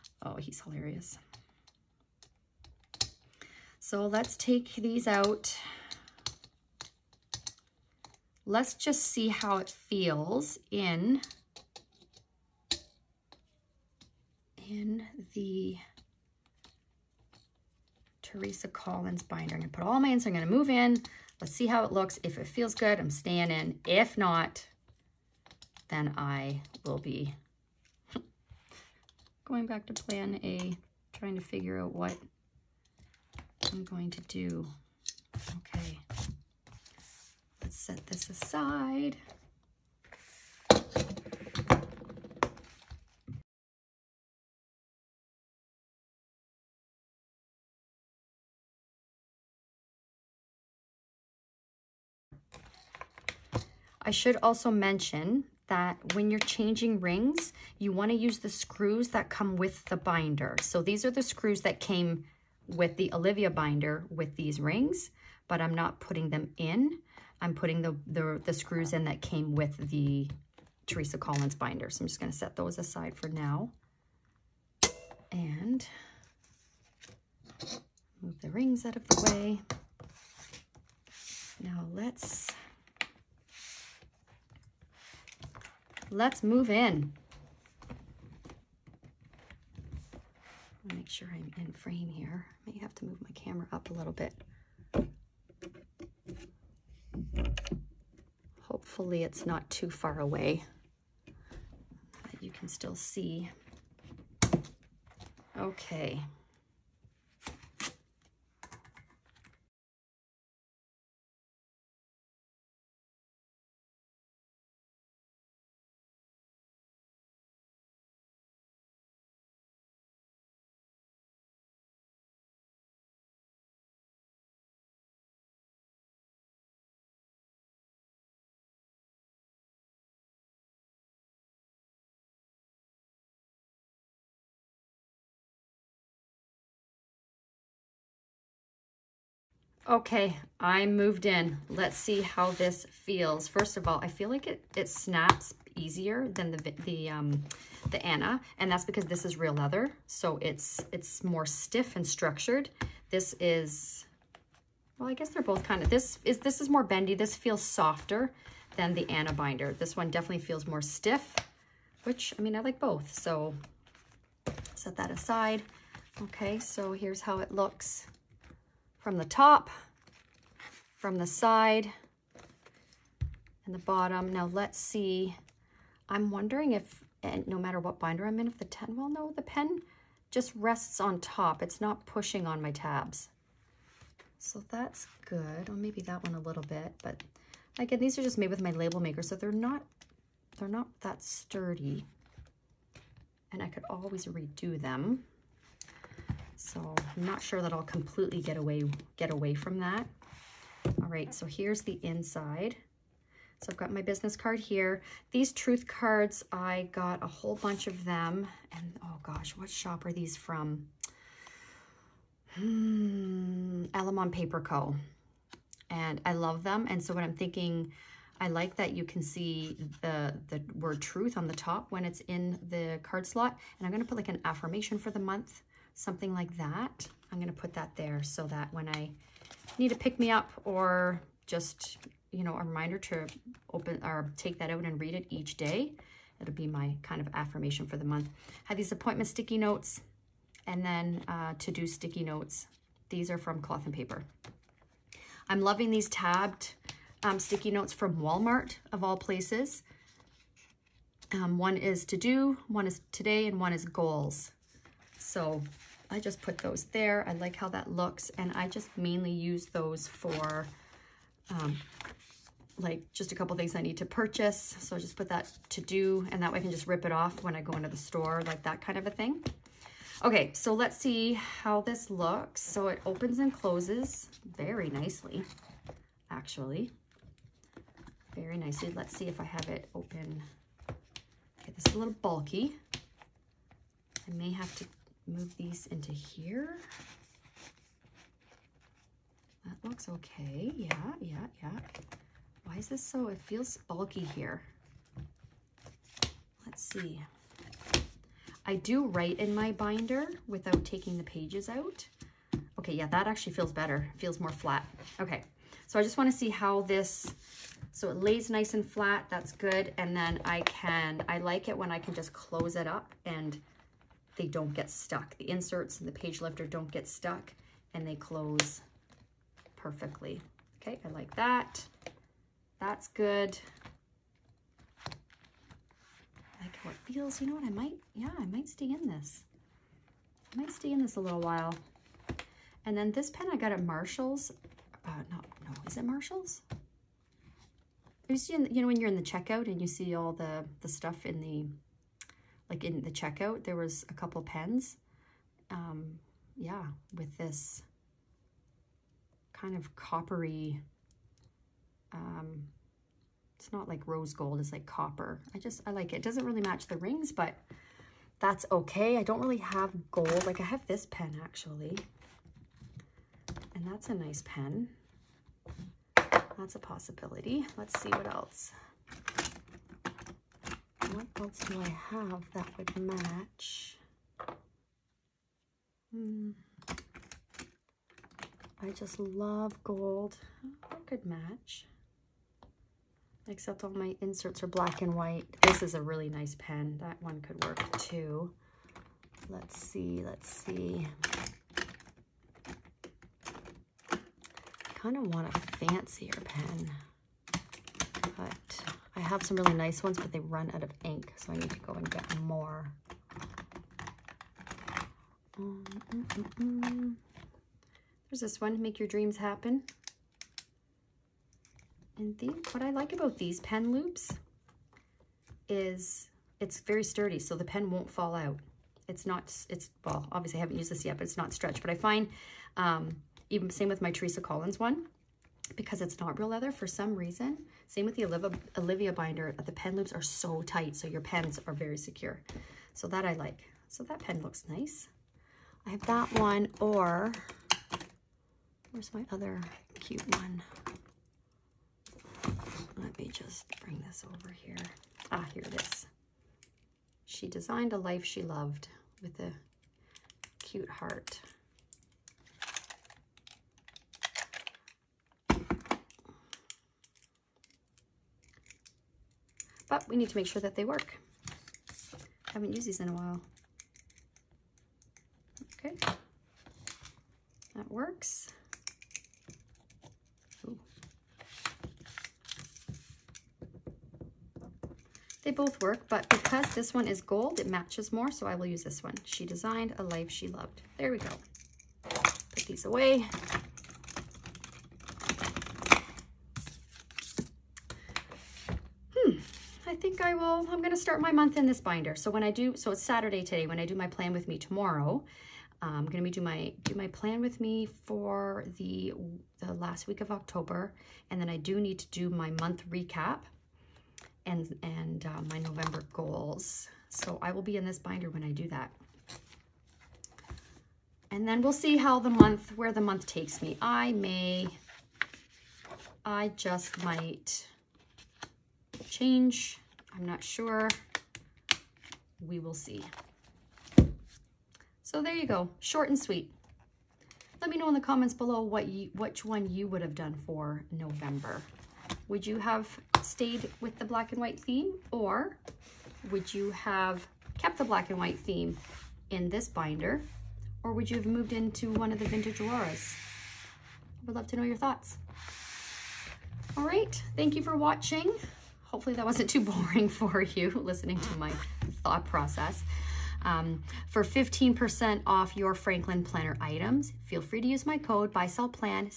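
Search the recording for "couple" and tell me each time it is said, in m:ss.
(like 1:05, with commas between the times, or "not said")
4:23, 5:44.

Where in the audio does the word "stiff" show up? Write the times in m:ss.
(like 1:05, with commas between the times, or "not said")
2:31, 2:40.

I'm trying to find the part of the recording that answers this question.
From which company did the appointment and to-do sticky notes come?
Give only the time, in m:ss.
4:03.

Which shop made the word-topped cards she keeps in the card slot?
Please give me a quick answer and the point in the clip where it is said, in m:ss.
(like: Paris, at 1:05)
Alamon Paper Co., at 3:33.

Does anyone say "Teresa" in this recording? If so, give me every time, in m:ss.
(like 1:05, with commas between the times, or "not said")
0:18, 1:10, 7:04.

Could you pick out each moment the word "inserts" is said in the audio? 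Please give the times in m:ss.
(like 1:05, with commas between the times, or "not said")
5:15, 6:24.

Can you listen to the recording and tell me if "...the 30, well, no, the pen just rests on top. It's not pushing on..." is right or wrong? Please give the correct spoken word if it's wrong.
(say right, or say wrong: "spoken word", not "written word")
wrong: "10", not "30".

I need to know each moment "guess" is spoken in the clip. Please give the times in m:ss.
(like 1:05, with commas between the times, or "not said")
2:35.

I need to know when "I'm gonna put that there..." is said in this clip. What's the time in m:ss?
3:47.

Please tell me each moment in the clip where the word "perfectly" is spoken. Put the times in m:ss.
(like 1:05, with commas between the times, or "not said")
5:19.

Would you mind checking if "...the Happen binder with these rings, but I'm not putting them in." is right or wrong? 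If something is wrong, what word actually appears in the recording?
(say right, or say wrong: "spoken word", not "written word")
wrong: "Olivia", not "Happen".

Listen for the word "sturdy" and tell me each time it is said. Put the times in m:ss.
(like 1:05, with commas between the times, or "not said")
3:11, 6:57.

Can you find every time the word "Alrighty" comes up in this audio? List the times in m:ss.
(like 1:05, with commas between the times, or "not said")
not said.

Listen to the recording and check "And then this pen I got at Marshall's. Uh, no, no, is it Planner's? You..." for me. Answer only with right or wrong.
wrong.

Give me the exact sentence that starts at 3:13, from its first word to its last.
And I could always redo them.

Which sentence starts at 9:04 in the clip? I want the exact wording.
I would love to know your thoughts.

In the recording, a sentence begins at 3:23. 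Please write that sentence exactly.
So I've got my business card here.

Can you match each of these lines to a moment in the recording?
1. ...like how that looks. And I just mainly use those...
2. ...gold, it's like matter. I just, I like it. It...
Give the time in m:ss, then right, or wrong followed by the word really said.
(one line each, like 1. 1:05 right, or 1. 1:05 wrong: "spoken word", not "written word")
1. 4:17 right
2. 5:54 wrong: "copper", not "matter".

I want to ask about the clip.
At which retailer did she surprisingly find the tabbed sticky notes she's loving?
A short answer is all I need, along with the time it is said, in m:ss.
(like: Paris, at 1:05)
Walmart, at 4:08.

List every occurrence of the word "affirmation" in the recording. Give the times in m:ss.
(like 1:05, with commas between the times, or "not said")
3:44, 3:57.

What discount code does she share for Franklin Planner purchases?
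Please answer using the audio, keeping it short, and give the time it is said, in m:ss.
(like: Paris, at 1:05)
BuySellPlan, at 9:18.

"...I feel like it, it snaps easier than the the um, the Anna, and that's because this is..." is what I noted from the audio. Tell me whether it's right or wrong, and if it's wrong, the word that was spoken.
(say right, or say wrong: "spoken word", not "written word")
right.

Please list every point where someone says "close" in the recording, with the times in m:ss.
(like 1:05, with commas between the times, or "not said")
4:33, 5:12, 5:18.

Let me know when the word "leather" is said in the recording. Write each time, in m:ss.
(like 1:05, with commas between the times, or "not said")
2:29, 7:06.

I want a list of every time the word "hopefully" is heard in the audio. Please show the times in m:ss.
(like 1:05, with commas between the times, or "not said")
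1:38, 9:08.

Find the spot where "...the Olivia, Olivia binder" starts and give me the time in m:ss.
7:08.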